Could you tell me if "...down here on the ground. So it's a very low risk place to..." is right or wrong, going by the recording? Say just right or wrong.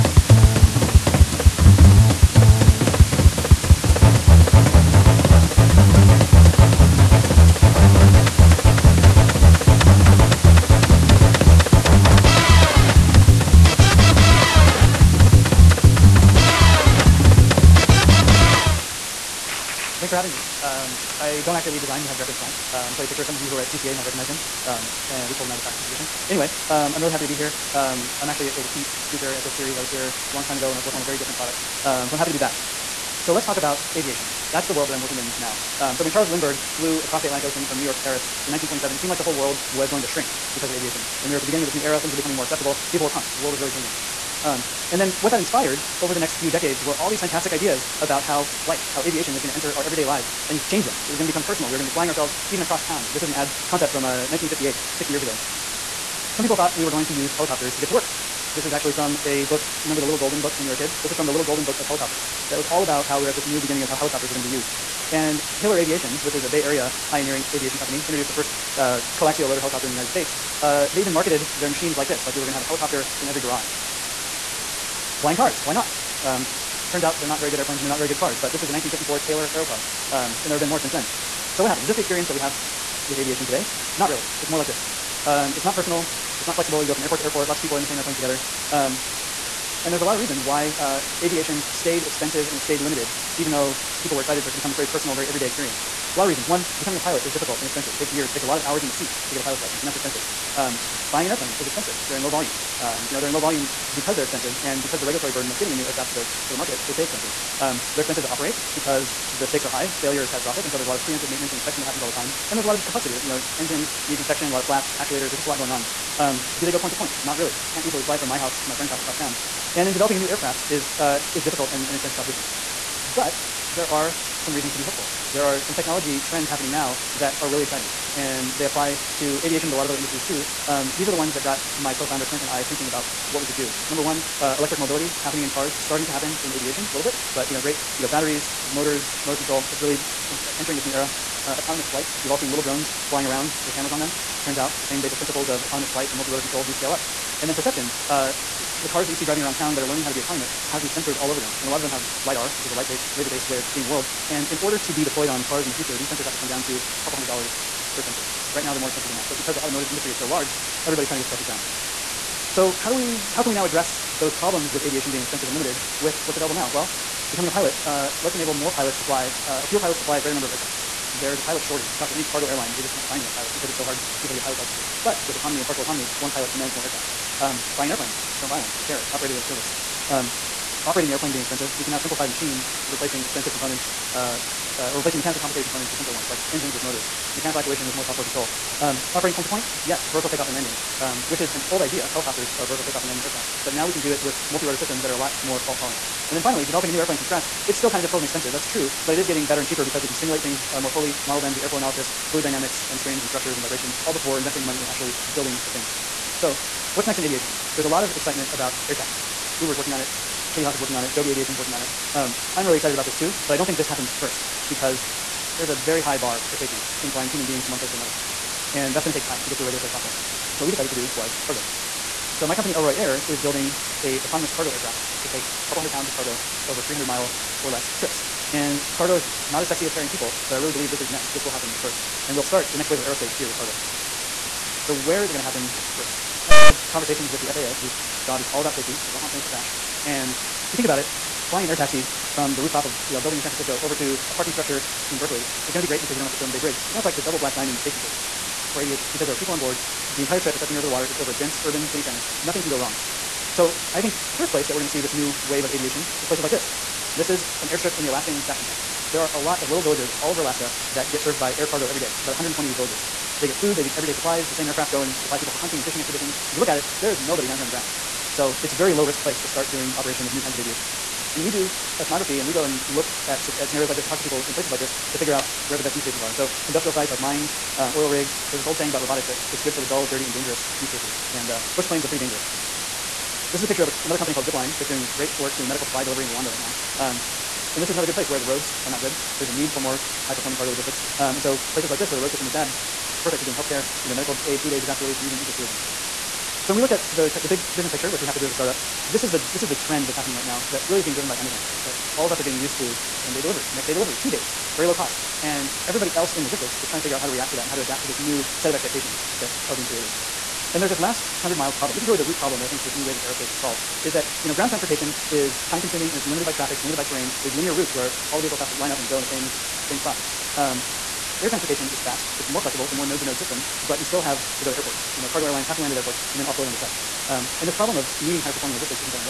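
right.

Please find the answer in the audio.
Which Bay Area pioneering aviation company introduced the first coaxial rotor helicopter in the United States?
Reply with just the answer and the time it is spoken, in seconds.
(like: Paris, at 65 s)
Hiller Aviation, at 65 s.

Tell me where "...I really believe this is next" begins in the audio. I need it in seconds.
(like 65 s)
230 s.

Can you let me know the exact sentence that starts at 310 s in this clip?
And there's this last 100 miles problem.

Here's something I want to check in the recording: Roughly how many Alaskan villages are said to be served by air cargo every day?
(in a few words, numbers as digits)
120.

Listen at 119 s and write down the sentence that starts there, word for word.
And then developing a new aircraft is, uh, is difficult and, and an expensive proposition.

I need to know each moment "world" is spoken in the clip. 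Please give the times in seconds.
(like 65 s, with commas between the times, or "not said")
34 s, 39 s, 43 s, 153 s.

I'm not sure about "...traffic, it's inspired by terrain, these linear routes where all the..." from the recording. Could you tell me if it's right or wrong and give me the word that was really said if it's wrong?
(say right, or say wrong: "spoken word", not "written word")
wrong: "limited", not "inspired".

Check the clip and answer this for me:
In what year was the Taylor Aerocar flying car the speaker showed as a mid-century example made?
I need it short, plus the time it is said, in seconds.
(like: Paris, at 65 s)
1954, at 78 s.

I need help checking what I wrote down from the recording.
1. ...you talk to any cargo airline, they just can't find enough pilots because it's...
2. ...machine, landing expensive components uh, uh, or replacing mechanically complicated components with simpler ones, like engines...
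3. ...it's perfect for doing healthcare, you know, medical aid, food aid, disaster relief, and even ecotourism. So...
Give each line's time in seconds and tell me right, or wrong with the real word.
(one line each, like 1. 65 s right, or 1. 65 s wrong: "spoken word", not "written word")
1. 171 s right
2. 182 s wrong: "replacing", not "landing"
3. 293 s right.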